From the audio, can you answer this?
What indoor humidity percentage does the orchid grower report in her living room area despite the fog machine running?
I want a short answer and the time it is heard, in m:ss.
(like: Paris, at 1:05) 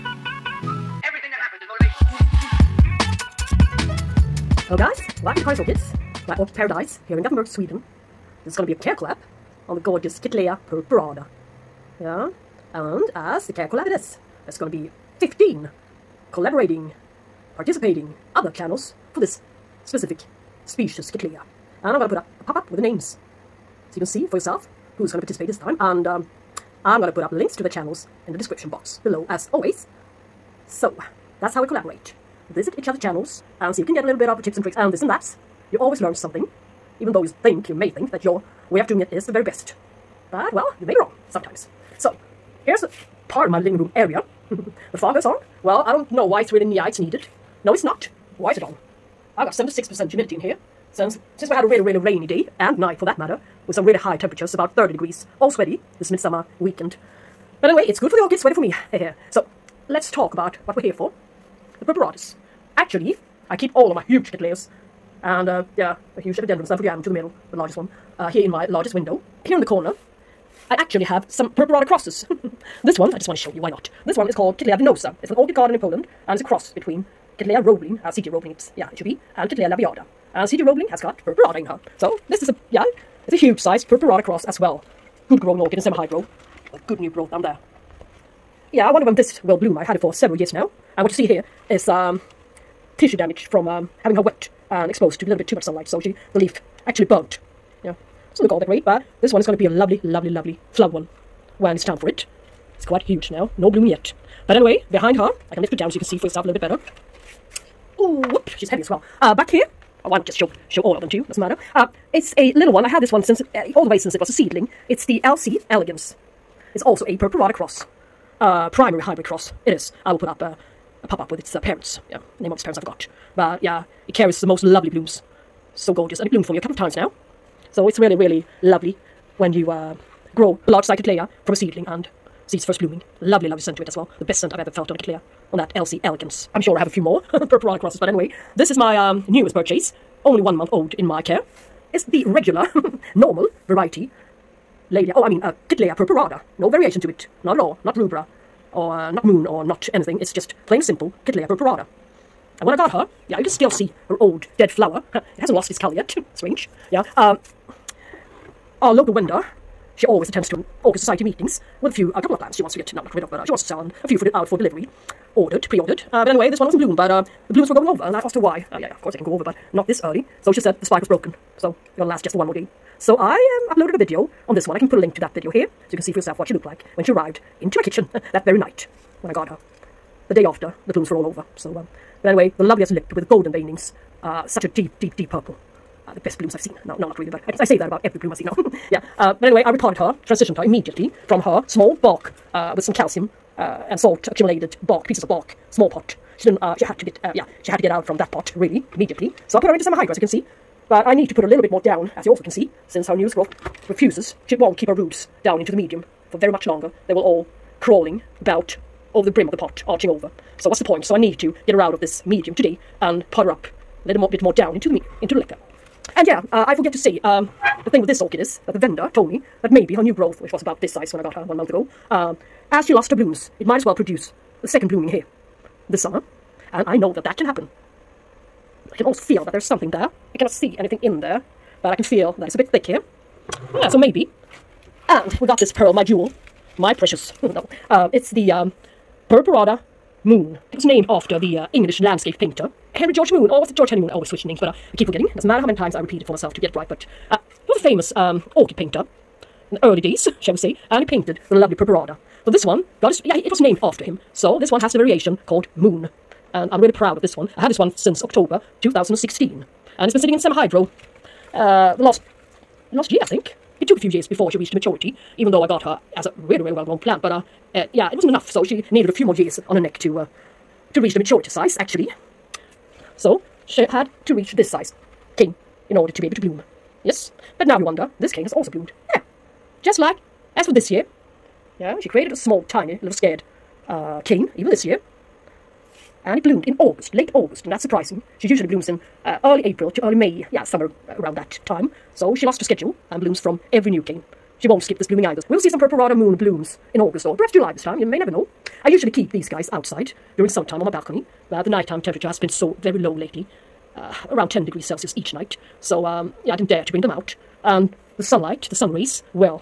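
76%, at 0:49.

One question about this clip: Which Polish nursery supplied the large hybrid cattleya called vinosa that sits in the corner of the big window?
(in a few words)
Orchid Garden.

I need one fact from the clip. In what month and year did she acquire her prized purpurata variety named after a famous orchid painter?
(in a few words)
October 2016.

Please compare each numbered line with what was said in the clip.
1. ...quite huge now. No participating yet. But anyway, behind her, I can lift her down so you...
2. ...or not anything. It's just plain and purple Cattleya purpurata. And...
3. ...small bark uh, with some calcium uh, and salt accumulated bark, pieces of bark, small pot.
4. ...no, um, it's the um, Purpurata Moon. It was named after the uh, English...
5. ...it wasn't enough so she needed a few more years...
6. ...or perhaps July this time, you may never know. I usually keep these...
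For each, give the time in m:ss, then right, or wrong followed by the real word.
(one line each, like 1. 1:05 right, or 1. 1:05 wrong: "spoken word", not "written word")
1. 1:42 wrong: "blooming", not "participating"
2. 2:29 wrong: "simple", not "purple"
3. 3:11 right
4. 3:57 right
5. 4:28 right
6. 4:57 right.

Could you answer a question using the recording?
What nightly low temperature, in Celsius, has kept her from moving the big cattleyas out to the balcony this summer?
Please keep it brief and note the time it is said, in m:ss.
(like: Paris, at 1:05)
10 degrees, at 5:04.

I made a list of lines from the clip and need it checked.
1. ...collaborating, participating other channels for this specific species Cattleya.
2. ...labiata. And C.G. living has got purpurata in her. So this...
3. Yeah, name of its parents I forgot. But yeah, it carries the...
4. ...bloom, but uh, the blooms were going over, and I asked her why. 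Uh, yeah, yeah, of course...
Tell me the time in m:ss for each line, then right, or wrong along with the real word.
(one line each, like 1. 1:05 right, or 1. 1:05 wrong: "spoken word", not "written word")
1. 0:16 right
2. 1:19 wrong: "roebling", not "living"
3. 2:02 right
4. 2:46 right.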